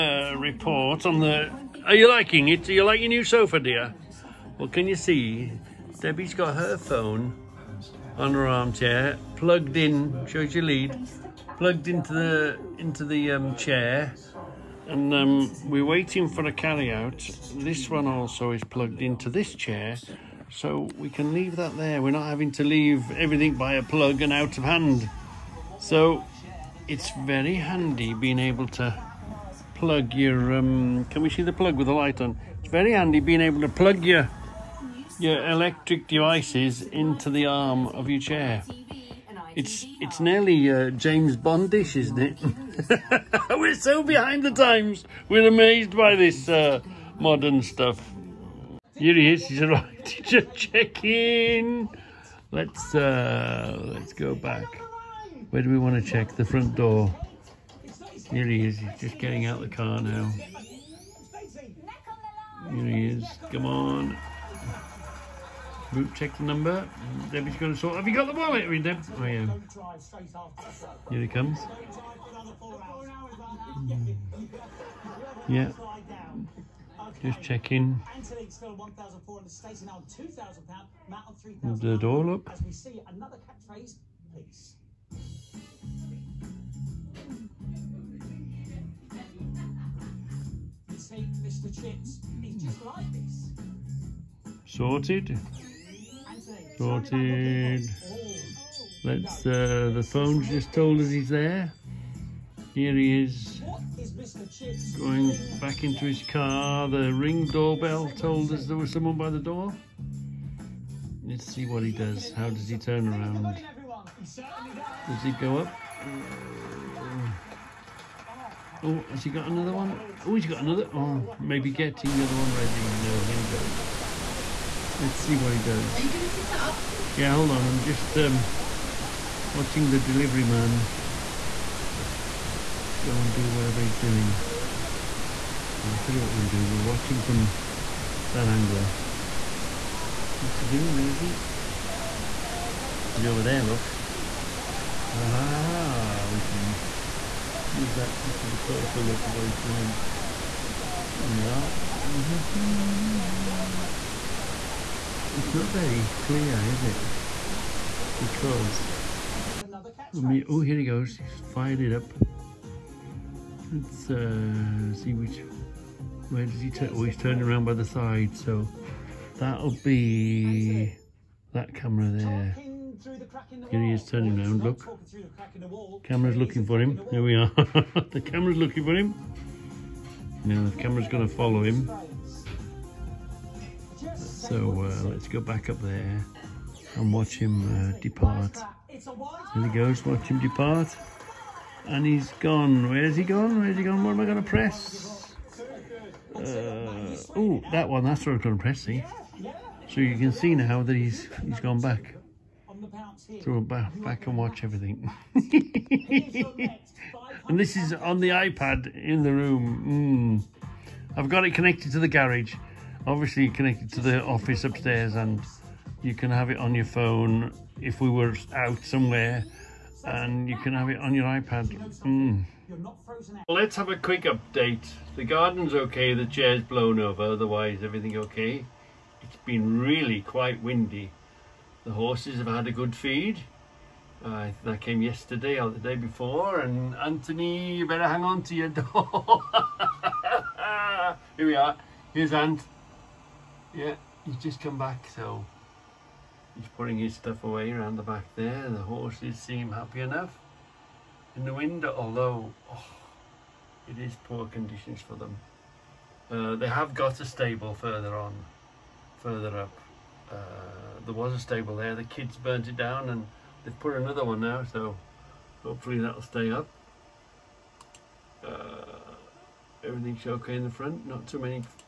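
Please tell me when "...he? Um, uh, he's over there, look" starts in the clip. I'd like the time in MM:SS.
02:21.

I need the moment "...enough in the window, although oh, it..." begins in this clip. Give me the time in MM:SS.
04:10.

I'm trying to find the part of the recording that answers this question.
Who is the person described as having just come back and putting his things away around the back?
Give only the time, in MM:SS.
04:02.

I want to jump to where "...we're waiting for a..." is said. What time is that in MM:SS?
00:15.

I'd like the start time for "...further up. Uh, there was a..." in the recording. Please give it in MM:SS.
04:19.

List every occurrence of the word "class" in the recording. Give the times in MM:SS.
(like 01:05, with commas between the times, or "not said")
not said.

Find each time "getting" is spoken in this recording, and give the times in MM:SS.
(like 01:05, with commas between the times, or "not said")
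00:59, 02:01.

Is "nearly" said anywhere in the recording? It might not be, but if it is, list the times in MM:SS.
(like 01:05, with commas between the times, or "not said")
00:40.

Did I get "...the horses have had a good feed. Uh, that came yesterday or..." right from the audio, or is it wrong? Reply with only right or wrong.
right.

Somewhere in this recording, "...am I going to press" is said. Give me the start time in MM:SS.
03:14.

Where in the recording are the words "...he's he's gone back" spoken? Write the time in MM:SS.
03:20.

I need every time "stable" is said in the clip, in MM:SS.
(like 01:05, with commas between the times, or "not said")
04:17, 04:21.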